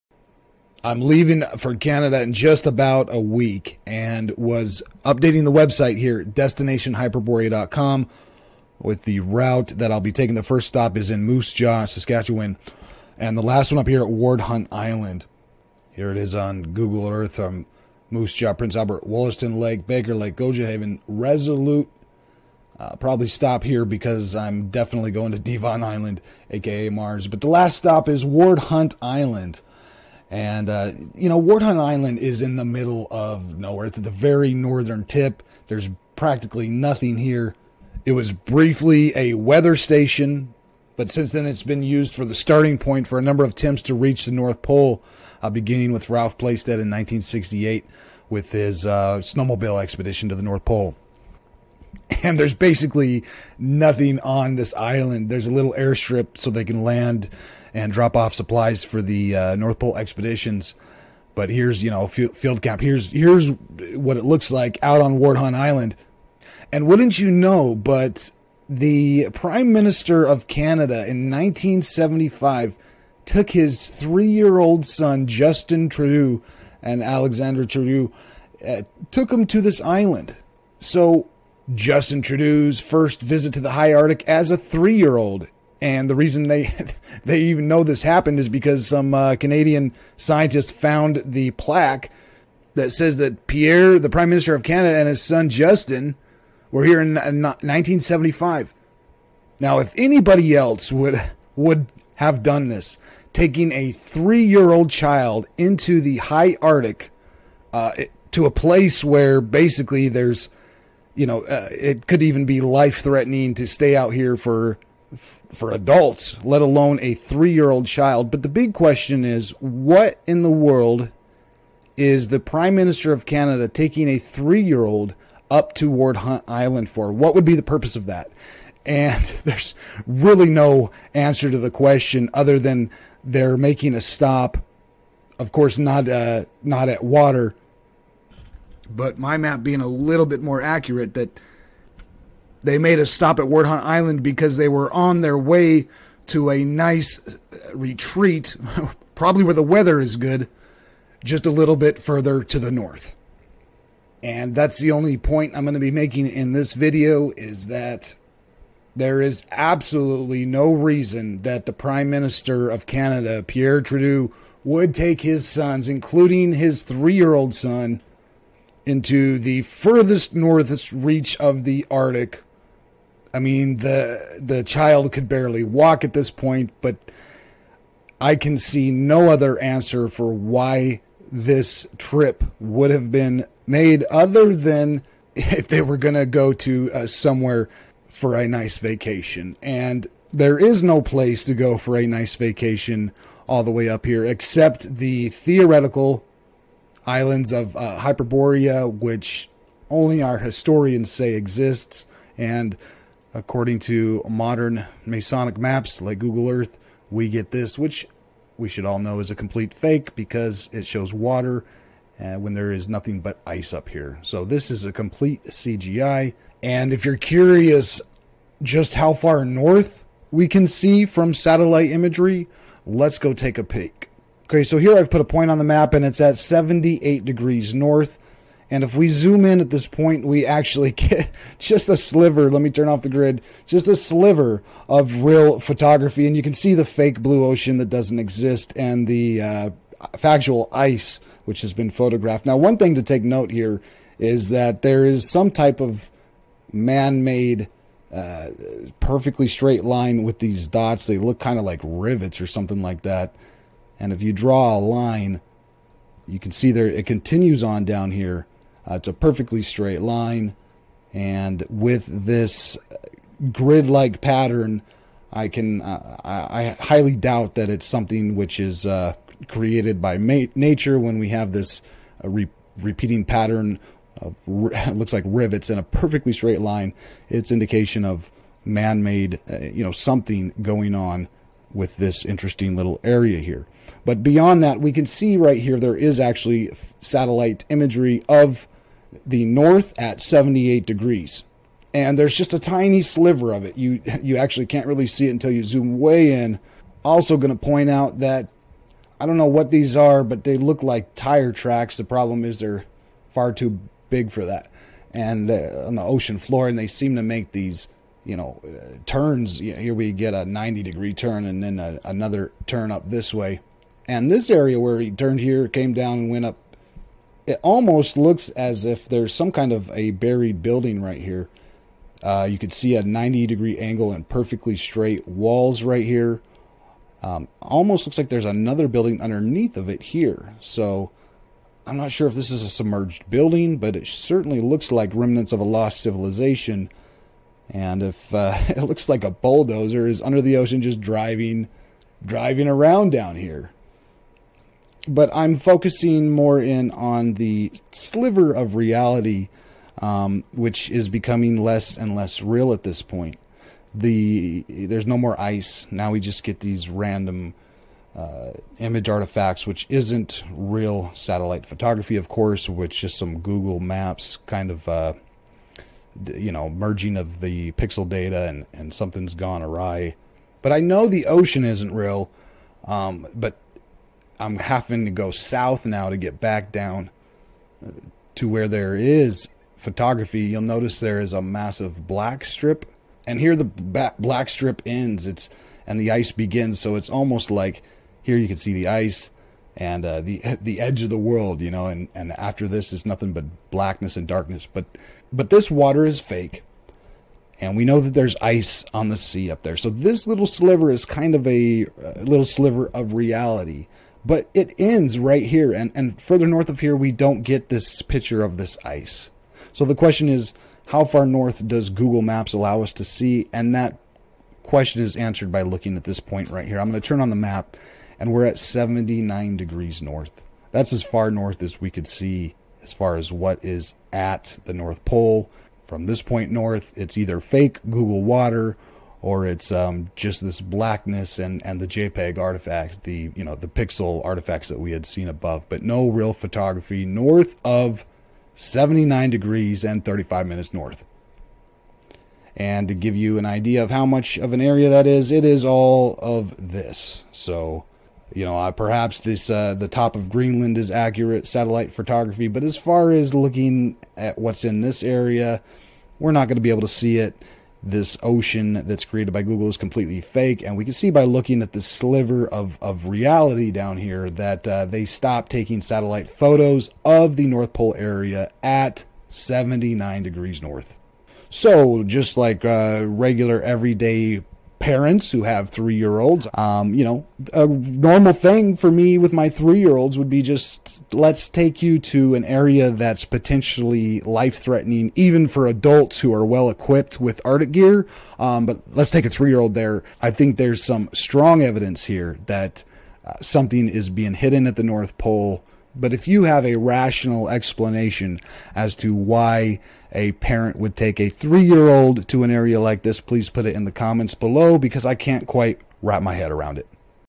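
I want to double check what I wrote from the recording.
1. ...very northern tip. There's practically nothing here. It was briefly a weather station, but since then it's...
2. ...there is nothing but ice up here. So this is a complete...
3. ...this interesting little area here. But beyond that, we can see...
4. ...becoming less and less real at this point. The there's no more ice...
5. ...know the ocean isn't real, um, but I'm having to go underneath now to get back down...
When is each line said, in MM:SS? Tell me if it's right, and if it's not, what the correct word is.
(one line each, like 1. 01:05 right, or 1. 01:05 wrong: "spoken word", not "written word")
1. 00:34 right
2. 03:32 right
3. 04:41 right
4. 05:51 right
5. 06:10 wrong: "south", not "underneath".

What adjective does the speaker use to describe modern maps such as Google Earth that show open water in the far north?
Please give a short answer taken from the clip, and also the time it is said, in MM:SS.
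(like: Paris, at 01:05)
Masonic, at 03:25.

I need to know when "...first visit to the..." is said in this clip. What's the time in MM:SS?
01:22.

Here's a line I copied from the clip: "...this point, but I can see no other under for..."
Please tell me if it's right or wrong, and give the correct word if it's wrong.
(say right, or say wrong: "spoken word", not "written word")
wrong: "answer", not "under".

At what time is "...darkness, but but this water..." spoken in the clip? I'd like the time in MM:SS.
06:34.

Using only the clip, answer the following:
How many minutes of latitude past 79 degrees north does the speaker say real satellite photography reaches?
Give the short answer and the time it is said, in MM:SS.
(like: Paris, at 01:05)
35 minutes, at 07:20.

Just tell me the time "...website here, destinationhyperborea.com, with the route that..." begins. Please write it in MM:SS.
00:05.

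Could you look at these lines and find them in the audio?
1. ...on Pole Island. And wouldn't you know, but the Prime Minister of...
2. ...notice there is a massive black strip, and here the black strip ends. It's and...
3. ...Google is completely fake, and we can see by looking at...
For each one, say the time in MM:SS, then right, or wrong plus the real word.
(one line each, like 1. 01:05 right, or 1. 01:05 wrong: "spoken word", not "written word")
1. 01:05 wrong: "Hunt", not "Pole"
2. 06:20 right
3. 07:39 right.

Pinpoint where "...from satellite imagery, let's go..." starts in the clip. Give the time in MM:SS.
03:41.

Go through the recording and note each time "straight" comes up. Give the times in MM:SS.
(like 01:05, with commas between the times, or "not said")
04:09, 04:19, 04:36, 05:24.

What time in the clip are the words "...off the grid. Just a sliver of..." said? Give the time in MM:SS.
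03:52.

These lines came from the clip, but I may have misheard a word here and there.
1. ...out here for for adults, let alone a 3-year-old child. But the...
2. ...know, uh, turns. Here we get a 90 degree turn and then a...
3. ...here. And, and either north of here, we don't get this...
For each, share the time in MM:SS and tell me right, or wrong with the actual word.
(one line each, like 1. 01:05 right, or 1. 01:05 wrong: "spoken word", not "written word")
1. 01:53 right
2. 05:08 right
3. 06:45 wrong: "further", not "either".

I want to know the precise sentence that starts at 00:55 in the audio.
There's a little airstrip so they can land and drop off supplies for the uh, North Pole expeditions.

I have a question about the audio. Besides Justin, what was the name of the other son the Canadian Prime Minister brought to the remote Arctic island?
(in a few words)
Alexander Trudeau.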